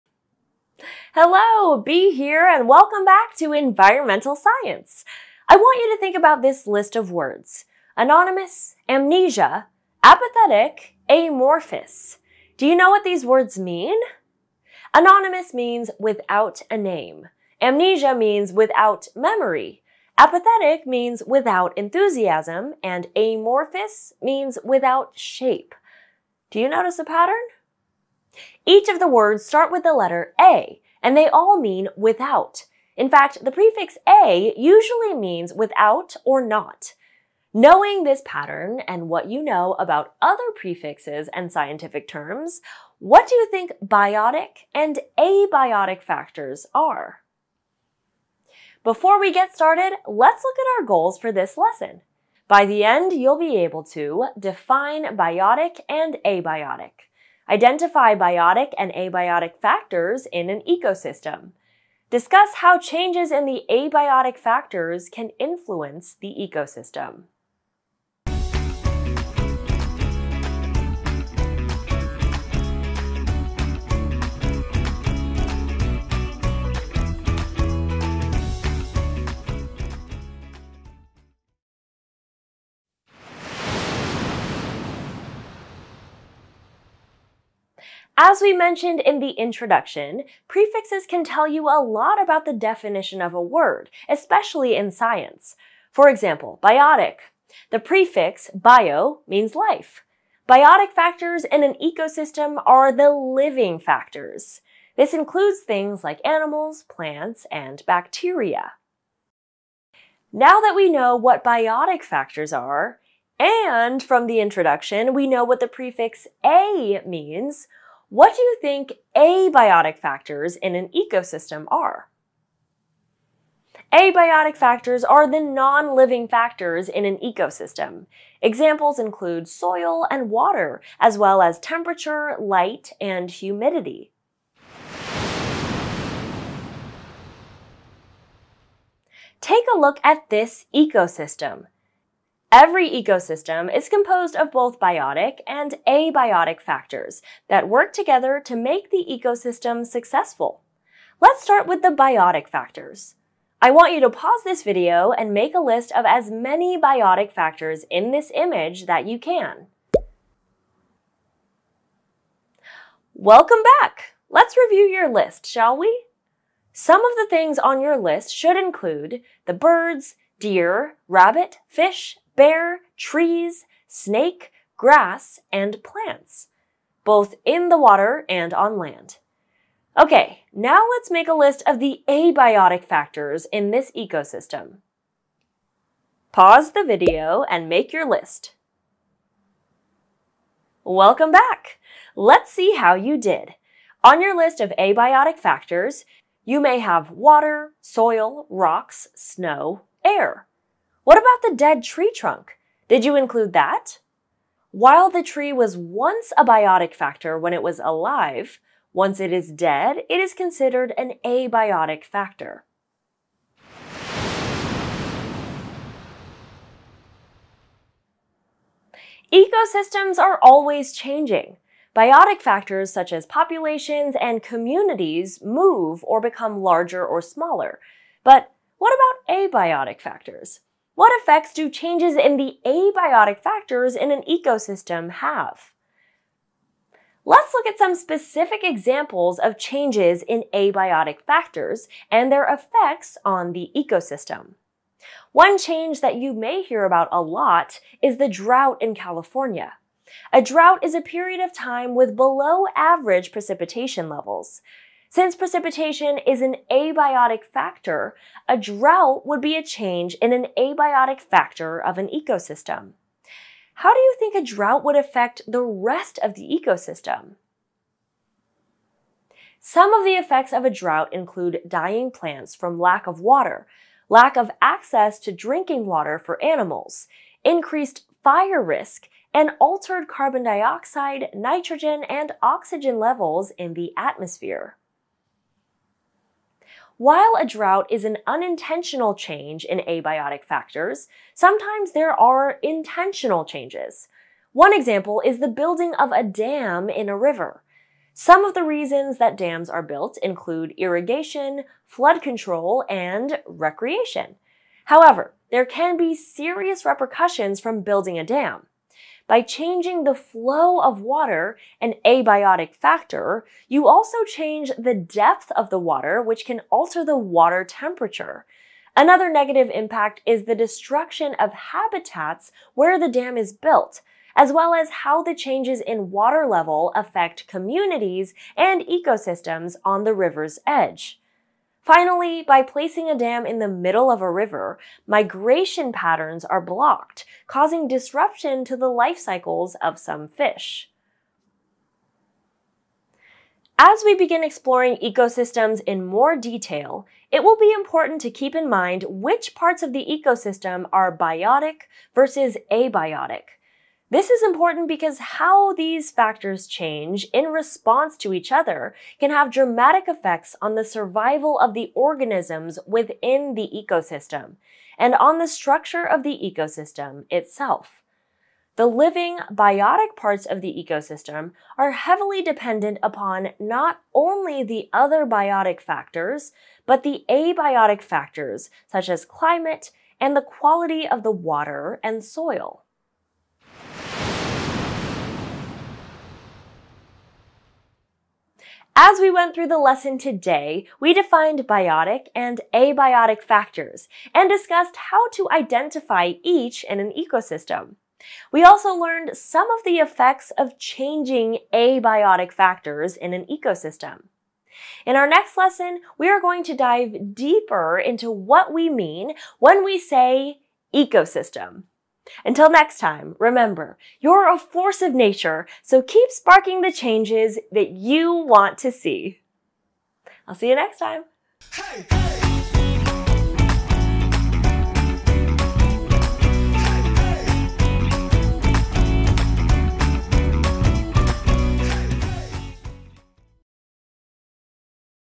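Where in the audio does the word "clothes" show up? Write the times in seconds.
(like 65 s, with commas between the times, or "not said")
not said.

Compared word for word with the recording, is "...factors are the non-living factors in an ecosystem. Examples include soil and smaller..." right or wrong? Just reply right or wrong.
wrong.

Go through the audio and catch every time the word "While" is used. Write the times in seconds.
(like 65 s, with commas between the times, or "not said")
204 s, 286 s.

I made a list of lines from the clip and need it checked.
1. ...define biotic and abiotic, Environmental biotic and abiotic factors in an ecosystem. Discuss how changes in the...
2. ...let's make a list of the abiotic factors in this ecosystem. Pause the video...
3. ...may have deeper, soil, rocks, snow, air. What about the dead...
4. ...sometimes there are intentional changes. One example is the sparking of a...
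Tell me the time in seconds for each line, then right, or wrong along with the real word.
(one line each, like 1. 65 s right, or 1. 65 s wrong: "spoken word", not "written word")
1. 54 s wrong: "Identify", not "Environmental"
2. 180 s right
3. 196 s wrong: "water", not "deeper"
4. 291 s wrong: "building", not "sparking".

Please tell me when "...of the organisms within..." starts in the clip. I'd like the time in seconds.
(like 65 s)
361 s.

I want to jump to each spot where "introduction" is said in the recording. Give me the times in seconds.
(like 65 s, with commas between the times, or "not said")
89 s, 114 s.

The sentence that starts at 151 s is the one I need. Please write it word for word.
Let's start with the biotic factors.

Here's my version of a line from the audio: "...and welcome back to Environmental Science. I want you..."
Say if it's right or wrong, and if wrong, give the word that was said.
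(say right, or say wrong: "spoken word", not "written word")
right.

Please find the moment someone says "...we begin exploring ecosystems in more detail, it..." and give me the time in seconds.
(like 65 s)
344 s.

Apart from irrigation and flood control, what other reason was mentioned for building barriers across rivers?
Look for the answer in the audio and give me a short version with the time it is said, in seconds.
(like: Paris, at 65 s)
Recreation, at 303 s.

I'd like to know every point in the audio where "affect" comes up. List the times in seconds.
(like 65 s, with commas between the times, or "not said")
264 s, 326 s.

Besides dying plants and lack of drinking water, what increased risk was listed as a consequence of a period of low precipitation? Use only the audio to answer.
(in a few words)
Fire risk.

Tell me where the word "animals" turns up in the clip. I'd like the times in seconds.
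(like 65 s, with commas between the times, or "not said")
106 s, 276 s.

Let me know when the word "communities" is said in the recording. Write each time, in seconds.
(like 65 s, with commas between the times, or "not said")
224 s, 327 s.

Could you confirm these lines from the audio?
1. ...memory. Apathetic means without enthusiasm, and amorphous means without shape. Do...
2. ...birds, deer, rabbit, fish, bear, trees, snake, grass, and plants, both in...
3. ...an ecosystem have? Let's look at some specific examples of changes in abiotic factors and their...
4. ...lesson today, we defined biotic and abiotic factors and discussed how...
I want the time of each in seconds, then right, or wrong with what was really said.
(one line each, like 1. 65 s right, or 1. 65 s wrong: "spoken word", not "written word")
1. 19 s right
2. 169 s right
3. 234 s right
4. 389 s right.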